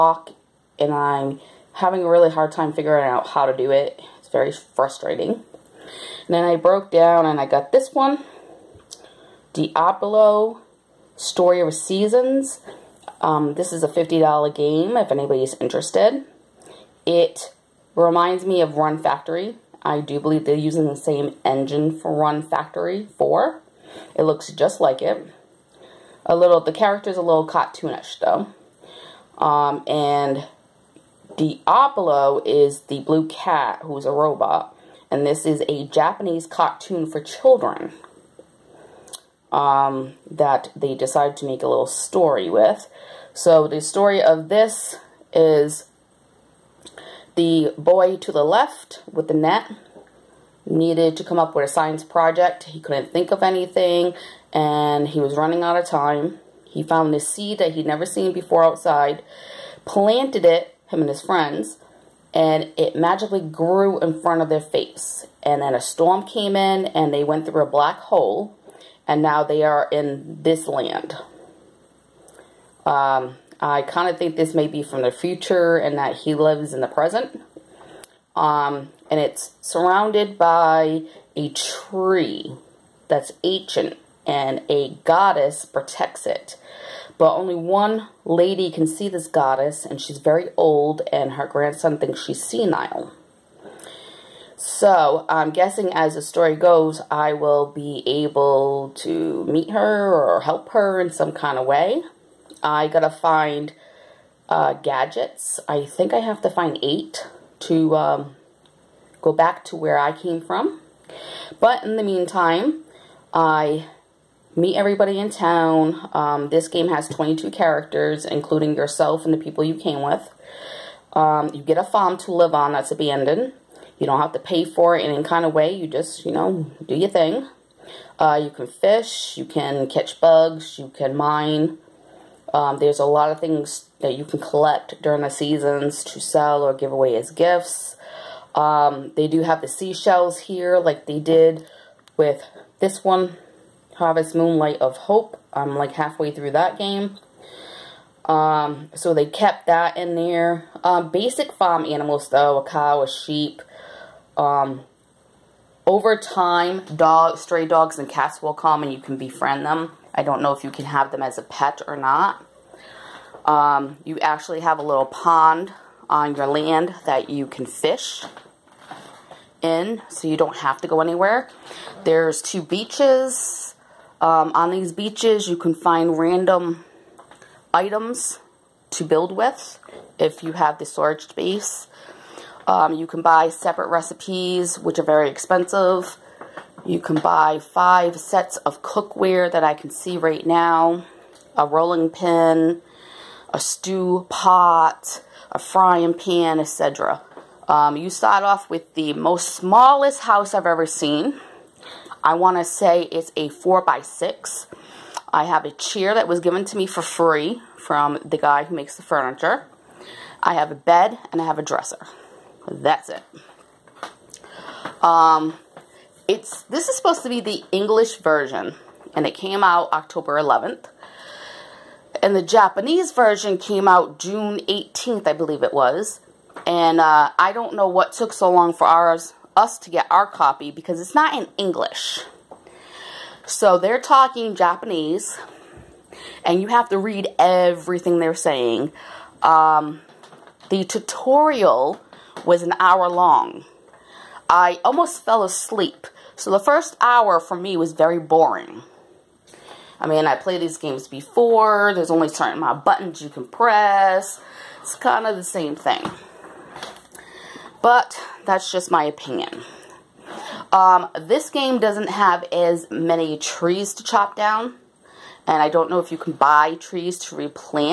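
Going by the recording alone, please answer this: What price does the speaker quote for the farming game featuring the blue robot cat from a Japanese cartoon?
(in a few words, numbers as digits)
$50.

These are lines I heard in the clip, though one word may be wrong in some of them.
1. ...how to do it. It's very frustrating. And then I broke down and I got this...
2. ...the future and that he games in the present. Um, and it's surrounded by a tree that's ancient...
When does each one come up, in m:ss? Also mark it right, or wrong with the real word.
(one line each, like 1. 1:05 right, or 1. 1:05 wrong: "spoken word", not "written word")
1. 0:03 right
2. 1:15 wrong: "lives", not "games".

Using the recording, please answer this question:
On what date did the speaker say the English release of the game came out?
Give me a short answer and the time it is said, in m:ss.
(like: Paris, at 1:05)
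October 11th, at 3:39.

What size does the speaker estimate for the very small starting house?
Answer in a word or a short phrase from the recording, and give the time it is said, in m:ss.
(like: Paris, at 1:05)
4 by 6, at 3:23.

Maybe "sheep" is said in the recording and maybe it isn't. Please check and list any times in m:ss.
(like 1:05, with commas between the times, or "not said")
2:33.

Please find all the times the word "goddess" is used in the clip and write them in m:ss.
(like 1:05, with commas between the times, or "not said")
1:25, 1:29.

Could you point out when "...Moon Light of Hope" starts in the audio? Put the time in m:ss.
2:24.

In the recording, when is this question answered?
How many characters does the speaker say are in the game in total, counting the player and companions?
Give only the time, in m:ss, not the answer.
1:57.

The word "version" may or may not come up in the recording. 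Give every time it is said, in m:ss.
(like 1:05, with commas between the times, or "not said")
3:38, 3:43.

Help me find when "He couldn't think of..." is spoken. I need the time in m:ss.
0:52.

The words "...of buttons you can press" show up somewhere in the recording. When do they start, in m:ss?
4:12.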